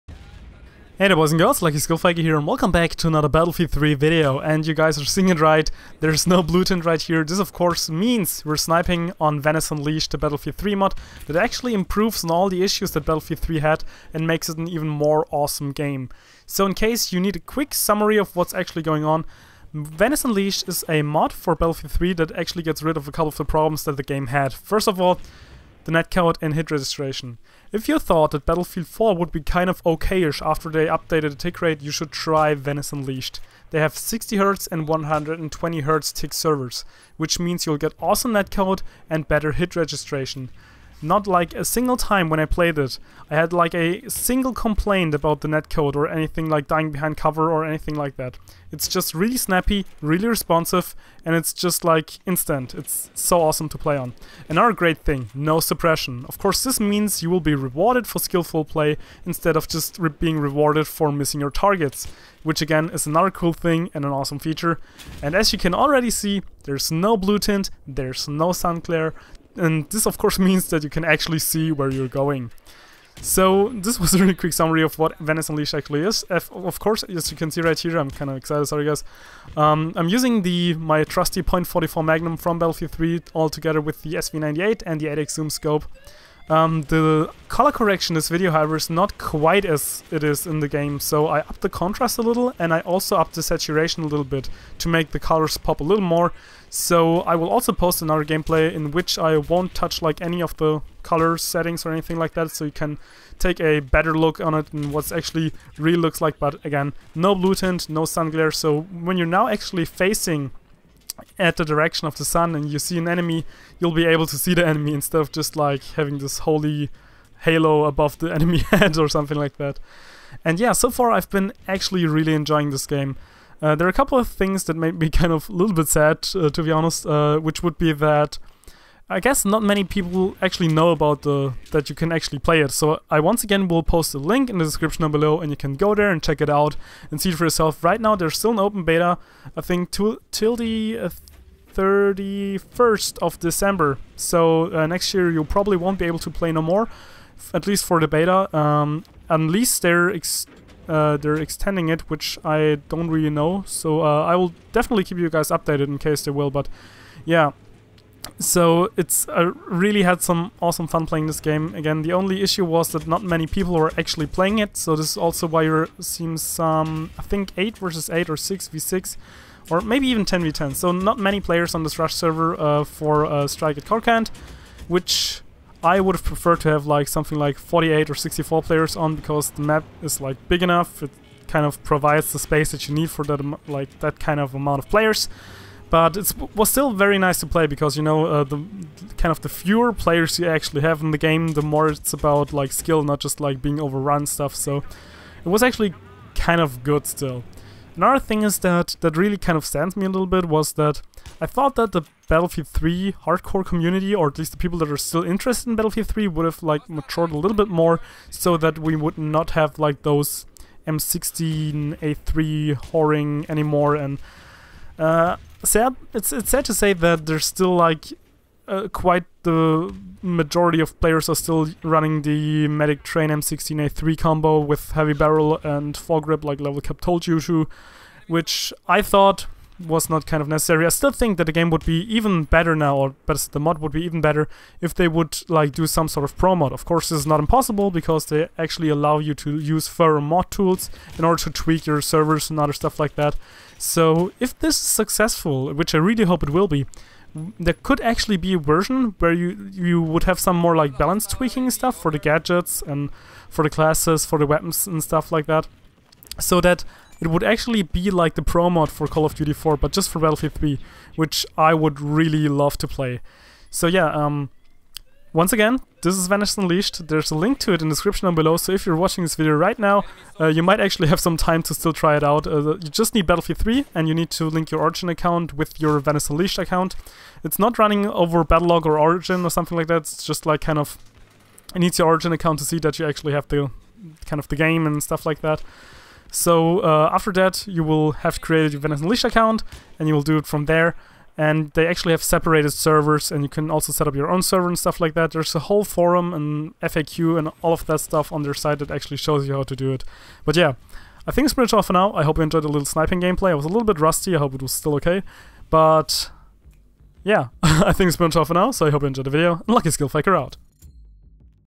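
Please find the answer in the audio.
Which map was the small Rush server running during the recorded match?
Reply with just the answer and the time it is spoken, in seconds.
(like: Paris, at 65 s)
Strike at Karkand, at 173 s.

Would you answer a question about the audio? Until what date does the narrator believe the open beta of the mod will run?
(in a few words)
31st of December.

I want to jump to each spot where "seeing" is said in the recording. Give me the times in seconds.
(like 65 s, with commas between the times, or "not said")
5 s, 165 s.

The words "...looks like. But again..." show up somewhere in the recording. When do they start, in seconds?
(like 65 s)
105 s.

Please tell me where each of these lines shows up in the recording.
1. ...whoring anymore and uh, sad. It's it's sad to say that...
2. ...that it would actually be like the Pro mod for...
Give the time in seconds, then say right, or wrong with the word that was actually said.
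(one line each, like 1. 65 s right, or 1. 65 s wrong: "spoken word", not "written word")
1. 212 s right
2. 256 s right.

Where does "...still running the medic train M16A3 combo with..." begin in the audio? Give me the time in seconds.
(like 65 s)
221 s.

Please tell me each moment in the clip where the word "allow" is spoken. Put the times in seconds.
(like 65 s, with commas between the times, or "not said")
238 s.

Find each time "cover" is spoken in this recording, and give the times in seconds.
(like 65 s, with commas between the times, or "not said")
47 s.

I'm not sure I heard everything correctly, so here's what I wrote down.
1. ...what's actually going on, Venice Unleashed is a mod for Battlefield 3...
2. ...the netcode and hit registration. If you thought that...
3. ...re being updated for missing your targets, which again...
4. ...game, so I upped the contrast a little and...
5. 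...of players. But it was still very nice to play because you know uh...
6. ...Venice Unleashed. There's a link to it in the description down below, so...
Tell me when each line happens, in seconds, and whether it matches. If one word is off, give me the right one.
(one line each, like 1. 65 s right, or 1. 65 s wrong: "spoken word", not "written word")
1. 18 s right
2. 25 s right
3. 59 s wrong: "rewarded", not "updated"
4. 90 s right
5. 184 s right
6. 266 s right.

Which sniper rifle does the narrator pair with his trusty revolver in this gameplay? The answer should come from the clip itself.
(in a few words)
SV98.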